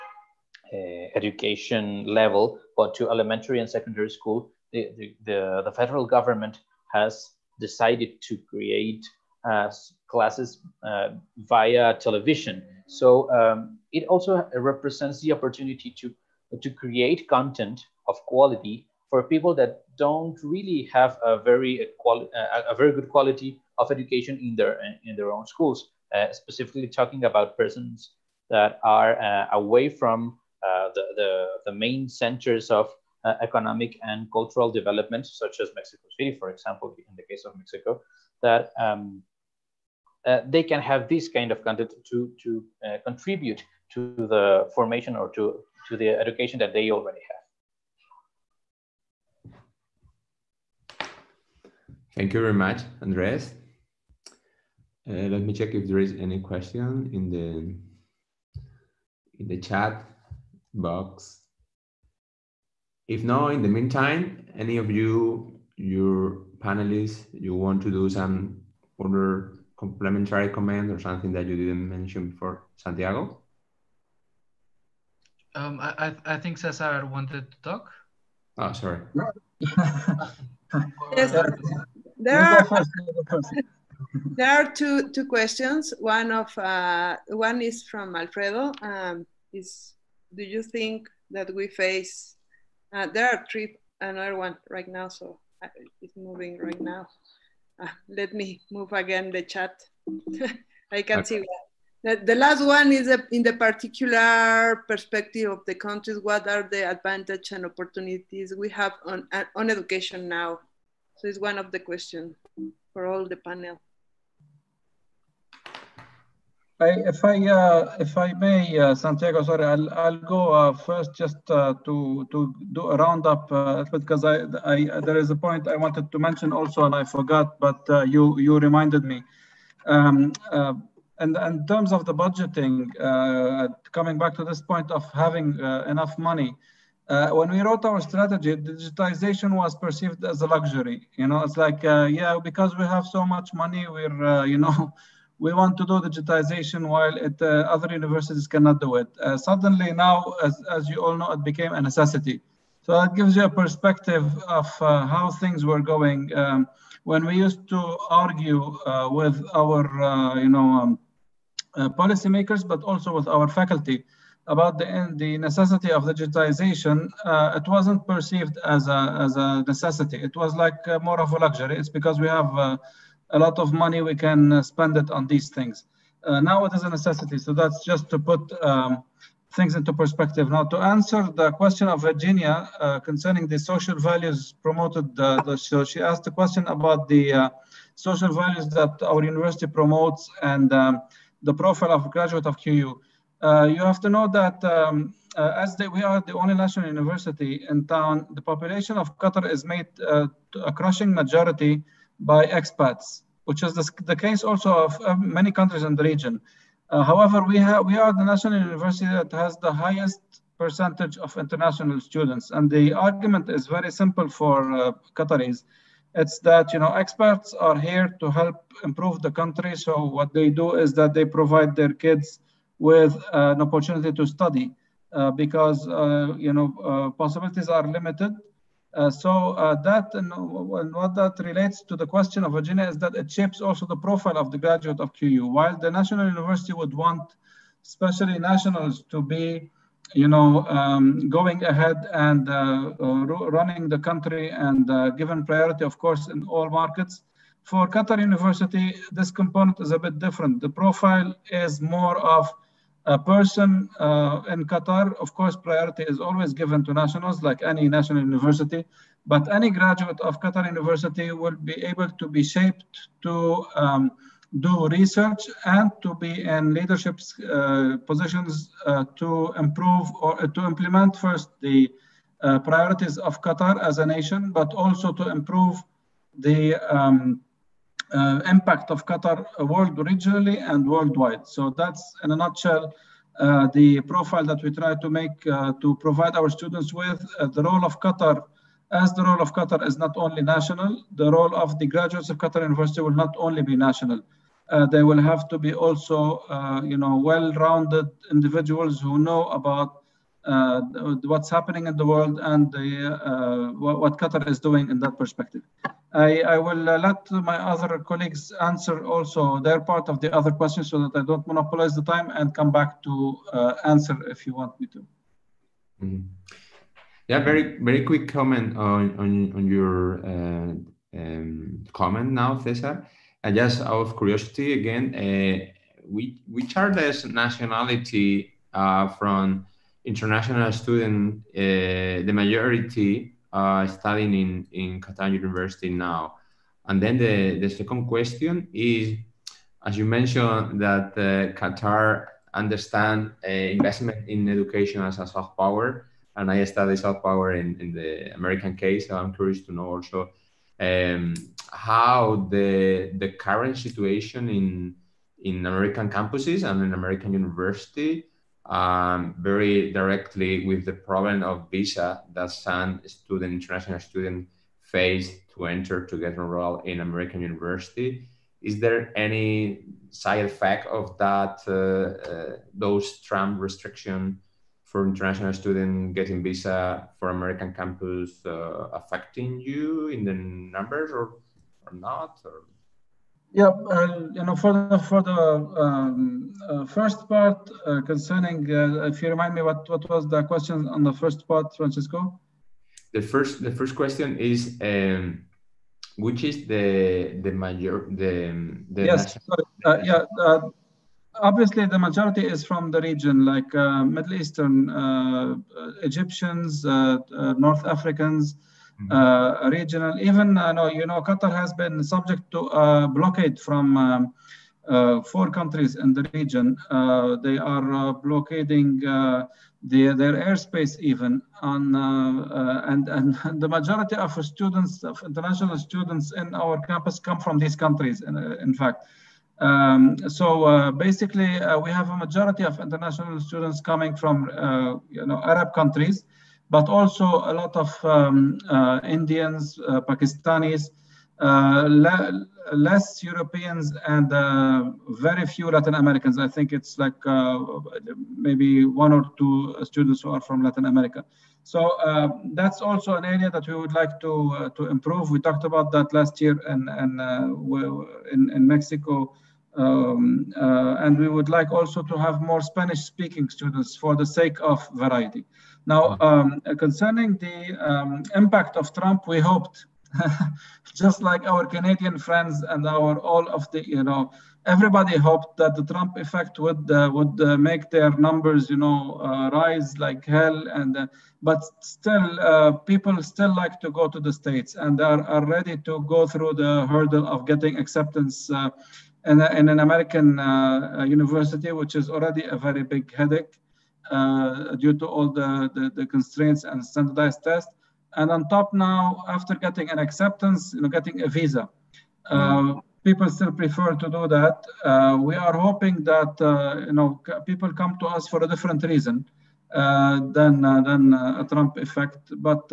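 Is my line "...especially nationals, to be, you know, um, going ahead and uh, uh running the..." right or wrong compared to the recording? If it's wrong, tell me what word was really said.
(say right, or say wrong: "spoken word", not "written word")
right.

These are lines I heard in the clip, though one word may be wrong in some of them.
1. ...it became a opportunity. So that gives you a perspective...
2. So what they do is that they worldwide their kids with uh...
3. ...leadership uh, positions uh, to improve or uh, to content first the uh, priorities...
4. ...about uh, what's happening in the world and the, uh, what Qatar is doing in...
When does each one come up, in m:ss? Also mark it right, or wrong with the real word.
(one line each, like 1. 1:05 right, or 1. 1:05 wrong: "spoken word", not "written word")
1. 2:31 wrong: "necessity", not "opportunity"
2. 3:39 wrong: "provide", not "worldwide"
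3. 4:26 wrong: "implement", not "content"
4. 4:59 right.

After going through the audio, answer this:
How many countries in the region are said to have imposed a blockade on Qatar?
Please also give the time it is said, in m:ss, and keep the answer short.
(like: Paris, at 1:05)
4, at 6:55.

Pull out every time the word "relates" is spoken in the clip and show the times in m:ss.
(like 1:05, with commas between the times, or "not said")
3:51.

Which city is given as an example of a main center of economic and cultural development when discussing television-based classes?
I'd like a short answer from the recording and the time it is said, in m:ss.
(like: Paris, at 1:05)
Mexico City, at 0:35.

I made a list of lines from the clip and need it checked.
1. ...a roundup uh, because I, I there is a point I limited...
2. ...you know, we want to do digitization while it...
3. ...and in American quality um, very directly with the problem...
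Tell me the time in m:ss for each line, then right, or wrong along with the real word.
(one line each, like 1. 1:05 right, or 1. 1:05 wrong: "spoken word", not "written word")
1. 2:02 wrong: "wanted", not "limited"
2. 2:24 right
3. 5:56 wrong: "university", not "quality".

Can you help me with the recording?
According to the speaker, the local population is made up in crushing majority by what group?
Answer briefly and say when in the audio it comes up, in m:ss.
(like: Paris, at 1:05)
Expats, at 3:22.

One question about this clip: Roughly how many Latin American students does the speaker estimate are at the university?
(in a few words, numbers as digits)
One or two.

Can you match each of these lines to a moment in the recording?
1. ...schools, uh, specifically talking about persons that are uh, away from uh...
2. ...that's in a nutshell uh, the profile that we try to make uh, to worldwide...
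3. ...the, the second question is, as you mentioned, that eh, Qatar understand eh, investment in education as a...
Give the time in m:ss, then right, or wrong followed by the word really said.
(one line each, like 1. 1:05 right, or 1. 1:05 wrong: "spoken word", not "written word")
1. 0:25 right
2. 4:41 wrong: "provide", not "worldwide"
3. 5:37 right.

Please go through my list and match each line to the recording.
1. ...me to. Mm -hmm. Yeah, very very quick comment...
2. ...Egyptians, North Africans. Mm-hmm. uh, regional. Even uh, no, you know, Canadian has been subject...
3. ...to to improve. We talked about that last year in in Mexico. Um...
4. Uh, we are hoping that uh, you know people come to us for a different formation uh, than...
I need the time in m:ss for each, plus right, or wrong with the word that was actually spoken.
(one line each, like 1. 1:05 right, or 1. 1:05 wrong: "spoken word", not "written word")
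1. 5:14 right
2. 6:46 wrong: "Qatar", not "Canadian"
3. 7:34 right
4. 8:24 wrong: "reason", not "formation".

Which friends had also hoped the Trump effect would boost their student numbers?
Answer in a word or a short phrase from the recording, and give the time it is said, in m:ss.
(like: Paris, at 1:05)
Canadian friends, at 7:51.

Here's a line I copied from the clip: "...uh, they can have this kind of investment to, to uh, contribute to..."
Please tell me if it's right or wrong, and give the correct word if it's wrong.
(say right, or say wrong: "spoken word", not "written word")
wrong: "content", not "investment".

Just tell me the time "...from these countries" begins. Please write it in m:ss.
7:07.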